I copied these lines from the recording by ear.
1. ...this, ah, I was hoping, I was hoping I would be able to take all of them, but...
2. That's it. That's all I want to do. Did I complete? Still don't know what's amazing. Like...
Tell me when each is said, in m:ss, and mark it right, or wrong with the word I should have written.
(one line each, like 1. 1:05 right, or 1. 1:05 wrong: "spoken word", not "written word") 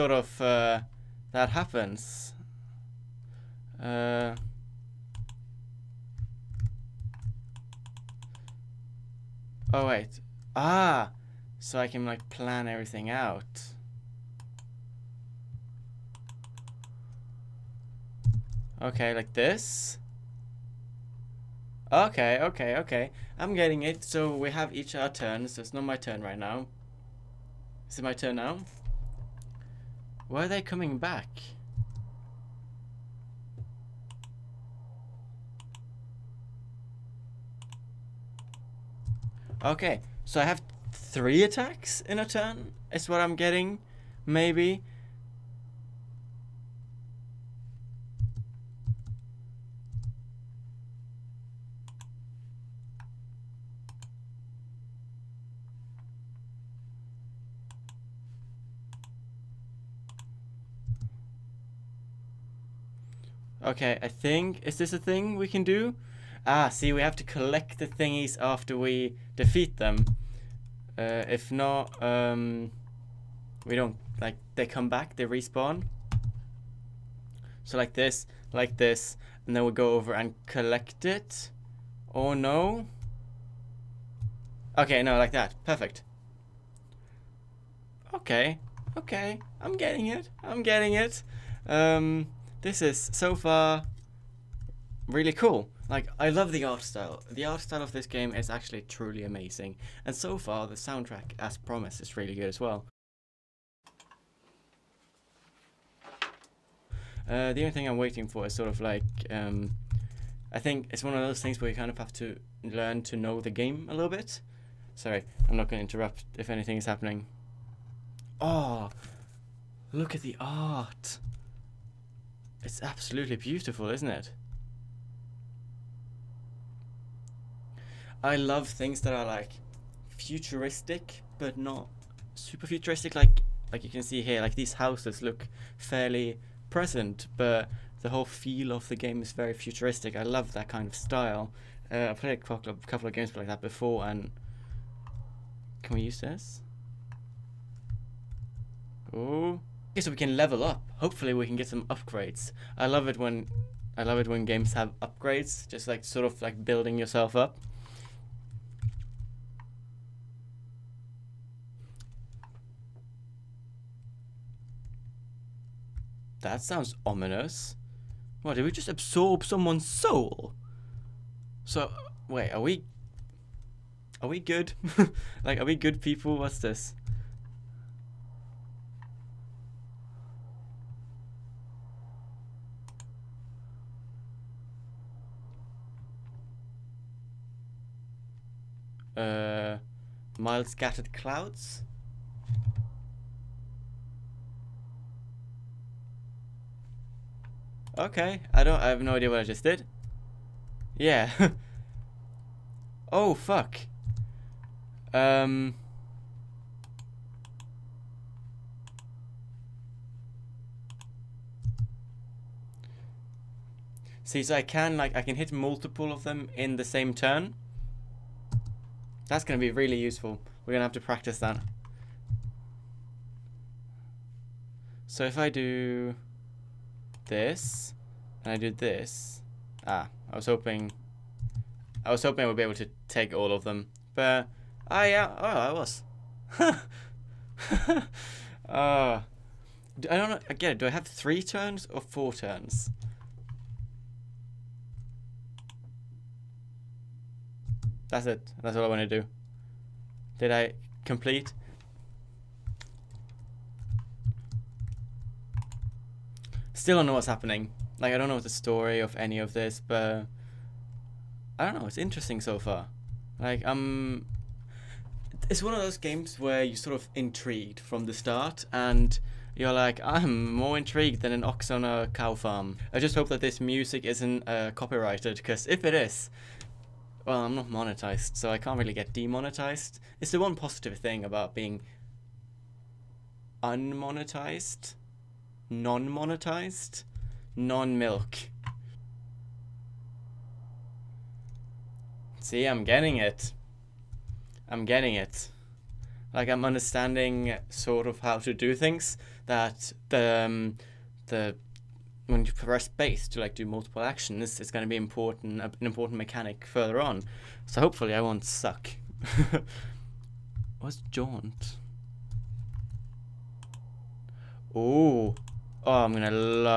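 1. 3:48 right
2. 4:08 wrong: "happening", not "amazing".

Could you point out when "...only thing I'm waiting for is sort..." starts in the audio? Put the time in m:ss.
1:47.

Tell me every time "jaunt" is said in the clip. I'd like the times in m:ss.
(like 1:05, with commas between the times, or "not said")
5:11.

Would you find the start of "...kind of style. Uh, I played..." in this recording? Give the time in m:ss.
2:20.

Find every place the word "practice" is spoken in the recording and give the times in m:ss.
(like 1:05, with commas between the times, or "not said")
3:41.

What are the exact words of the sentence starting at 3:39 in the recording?
That's going to be really useful.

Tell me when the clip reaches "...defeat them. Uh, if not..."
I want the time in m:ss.
1:09.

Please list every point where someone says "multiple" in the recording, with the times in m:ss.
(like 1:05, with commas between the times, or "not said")
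3:35, 5:03.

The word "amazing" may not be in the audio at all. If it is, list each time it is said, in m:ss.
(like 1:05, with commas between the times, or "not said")
1:39.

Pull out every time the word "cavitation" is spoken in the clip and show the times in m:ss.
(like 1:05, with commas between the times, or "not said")
not said.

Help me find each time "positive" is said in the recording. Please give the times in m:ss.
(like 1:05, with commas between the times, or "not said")
4:40.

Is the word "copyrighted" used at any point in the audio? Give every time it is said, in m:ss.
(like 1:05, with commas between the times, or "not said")
4:34.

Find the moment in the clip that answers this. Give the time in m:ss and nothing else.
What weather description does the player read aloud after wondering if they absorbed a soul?
3:10.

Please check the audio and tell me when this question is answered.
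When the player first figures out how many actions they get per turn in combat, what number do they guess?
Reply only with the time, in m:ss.
0:40.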